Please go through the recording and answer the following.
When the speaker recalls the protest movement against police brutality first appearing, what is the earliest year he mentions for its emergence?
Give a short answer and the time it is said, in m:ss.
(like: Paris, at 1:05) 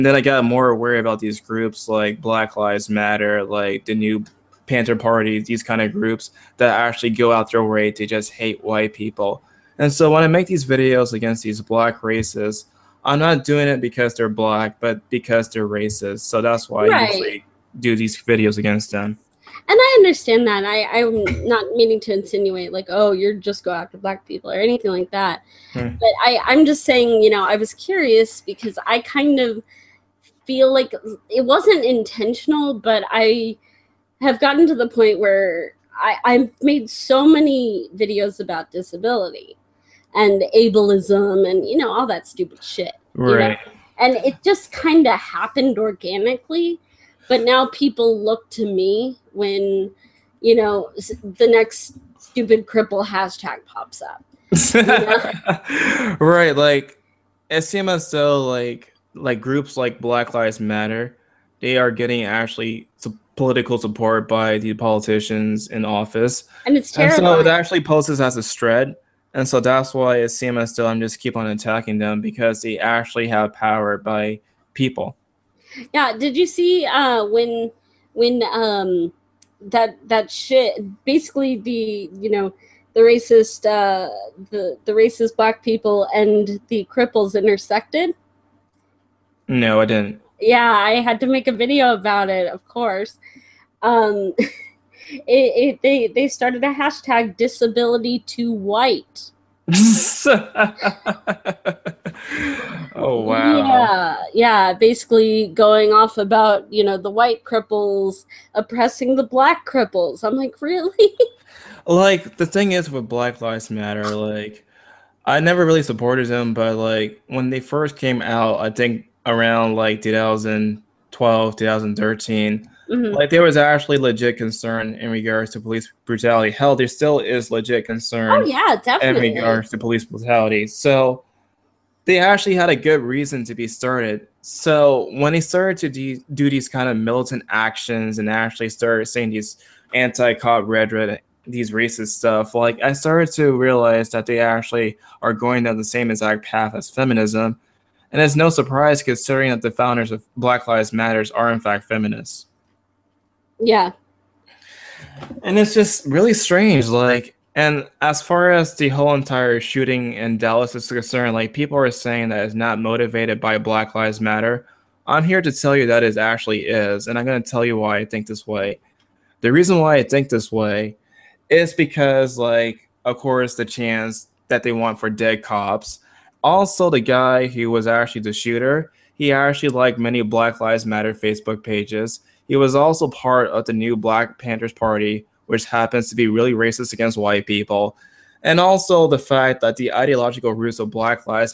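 2012, at 2:00.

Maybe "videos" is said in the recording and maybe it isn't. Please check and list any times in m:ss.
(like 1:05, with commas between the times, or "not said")
0:10, 0:18, 0:37, 1:31.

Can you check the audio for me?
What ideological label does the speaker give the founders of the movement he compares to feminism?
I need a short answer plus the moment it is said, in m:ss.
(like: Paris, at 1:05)
feminists, at 2:31.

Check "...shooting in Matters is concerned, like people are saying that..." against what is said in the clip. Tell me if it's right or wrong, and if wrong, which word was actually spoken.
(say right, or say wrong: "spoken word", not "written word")
wrong: "Dallas", not "Matters".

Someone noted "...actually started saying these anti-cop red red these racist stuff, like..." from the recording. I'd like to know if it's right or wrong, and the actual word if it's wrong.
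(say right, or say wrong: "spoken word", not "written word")
right.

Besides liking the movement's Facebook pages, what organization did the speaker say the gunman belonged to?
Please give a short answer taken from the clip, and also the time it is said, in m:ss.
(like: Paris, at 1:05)
New Black Panthers Party, at 3:03.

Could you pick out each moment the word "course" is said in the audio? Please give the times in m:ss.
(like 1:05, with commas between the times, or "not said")
1:32, 2:53.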